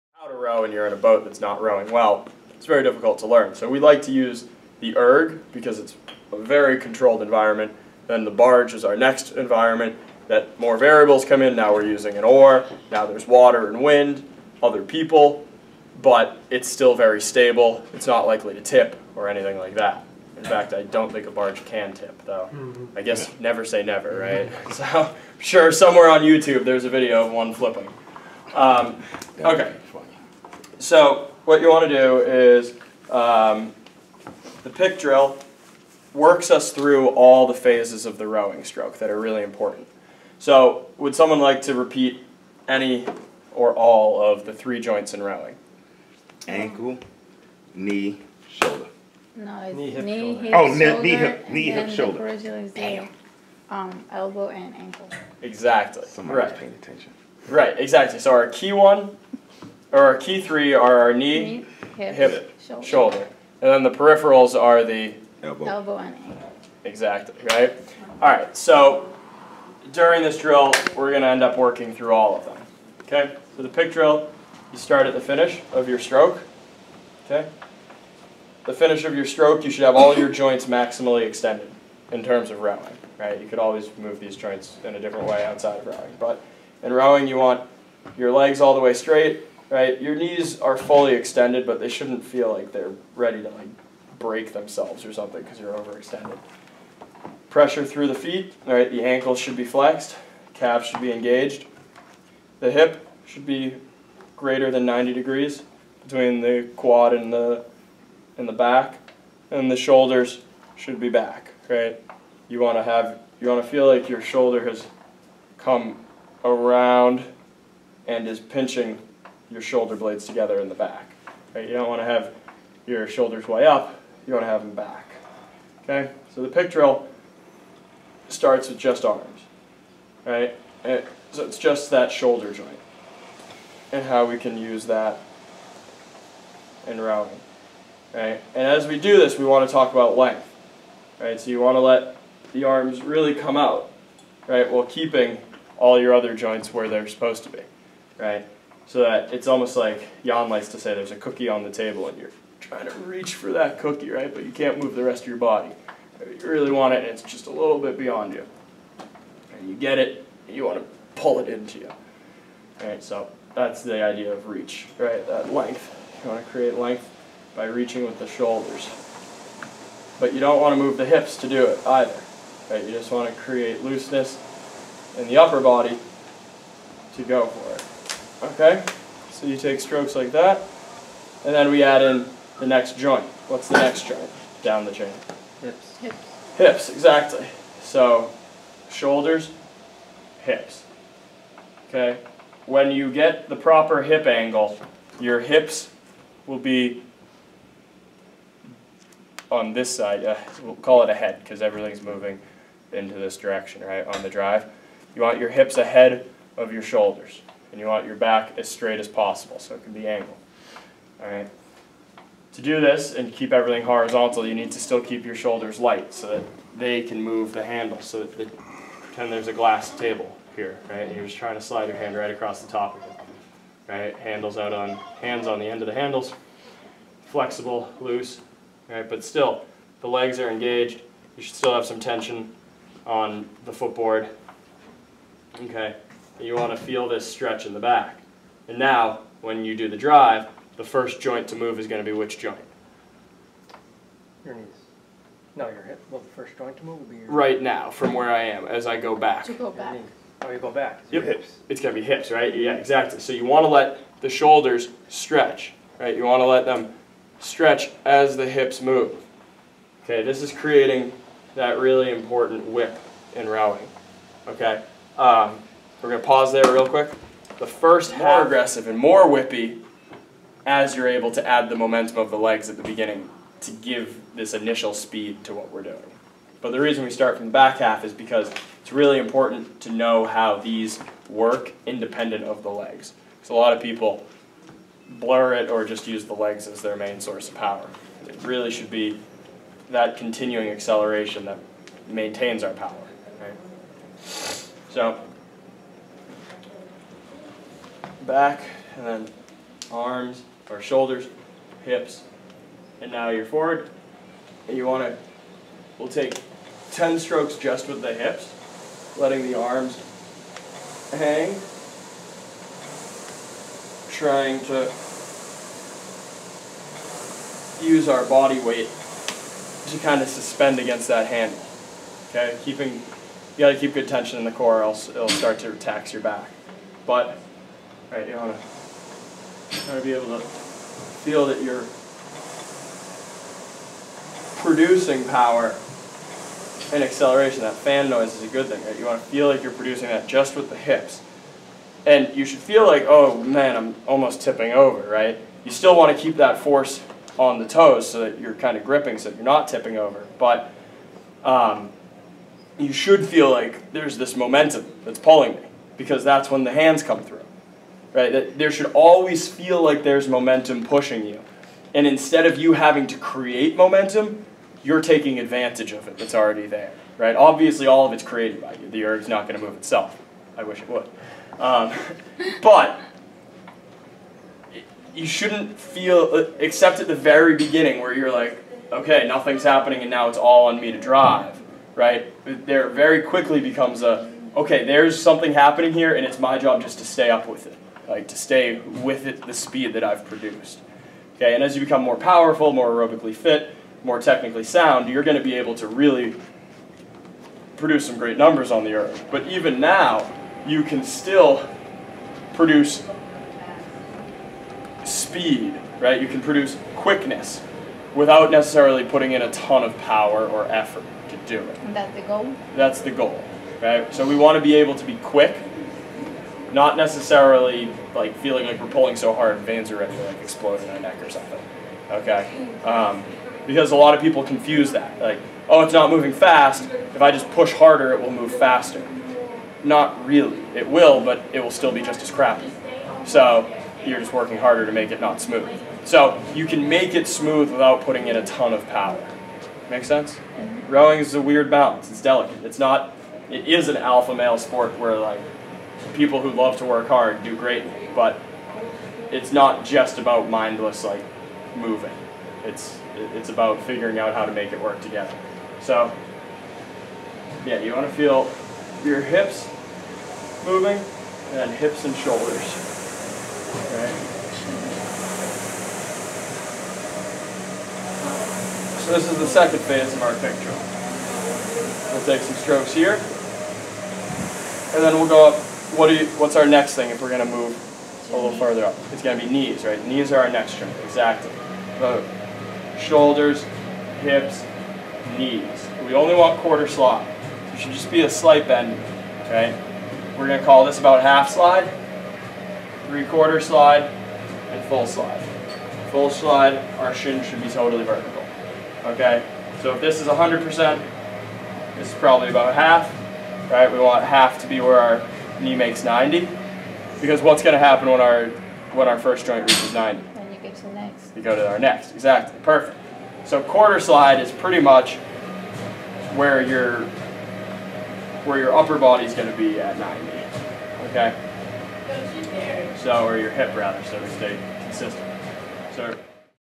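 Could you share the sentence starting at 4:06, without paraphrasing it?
Well, the first joint to move will be your Right now, from where I am, as I go back.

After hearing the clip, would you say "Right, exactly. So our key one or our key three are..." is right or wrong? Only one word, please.
right.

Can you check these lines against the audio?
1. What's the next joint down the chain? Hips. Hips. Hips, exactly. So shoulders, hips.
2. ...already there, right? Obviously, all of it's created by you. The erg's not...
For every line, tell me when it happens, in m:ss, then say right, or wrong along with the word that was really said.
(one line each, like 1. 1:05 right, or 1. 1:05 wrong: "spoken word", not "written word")
1. 3:03 right
2. 6:06 right.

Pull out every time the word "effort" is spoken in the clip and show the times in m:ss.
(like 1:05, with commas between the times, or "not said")
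6:50.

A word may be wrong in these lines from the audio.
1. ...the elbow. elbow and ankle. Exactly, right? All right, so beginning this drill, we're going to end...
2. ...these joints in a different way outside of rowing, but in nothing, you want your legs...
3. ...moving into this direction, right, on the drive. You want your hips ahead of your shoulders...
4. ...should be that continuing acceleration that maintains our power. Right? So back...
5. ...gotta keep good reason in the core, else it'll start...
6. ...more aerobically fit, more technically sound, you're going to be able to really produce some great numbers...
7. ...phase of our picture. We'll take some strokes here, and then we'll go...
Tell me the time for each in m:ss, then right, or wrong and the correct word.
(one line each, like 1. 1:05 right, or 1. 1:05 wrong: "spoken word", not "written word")
1. 1:04 wrong: "during", not "beginning"
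2. 1:24 wrong: "rowing", not "nothing"
3. 3:22 right
4. 4:48 right
5. 5:23 wrong: "tension", not "reason"
6. 6:32 right
7. 7:49 right.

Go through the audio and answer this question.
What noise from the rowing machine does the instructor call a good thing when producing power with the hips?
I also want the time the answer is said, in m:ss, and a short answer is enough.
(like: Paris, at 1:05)
fan noise, at 5:37.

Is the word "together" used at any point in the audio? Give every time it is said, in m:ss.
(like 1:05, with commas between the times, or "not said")
2:00, 7:35.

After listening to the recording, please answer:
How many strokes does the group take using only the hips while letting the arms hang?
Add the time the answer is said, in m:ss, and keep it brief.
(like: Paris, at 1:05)
10, at 5:06.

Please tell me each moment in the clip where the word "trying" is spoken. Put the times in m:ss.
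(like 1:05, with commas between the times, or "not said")
2:32, 3:41, 5:14.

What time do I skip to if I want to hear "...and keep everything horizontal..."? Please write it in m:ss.
3:33.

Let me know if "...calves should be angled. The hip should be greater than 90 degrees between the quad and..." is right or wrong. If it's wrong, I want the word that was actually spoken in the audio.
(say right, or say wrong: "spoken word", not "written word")
wrong: "engaged", not "angled".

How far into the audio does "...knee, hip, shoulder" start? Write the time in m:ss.
0:51.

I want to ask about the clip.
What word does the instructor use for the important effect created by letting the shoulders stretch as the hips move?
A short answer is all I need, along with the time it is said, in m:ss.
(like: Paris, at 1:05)
whip, at 4:22.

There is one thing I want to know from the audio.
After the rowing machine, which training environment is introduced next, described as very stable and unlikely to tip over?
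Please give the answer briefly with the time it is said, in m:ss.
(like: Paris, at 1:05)
the barge, at 0:08.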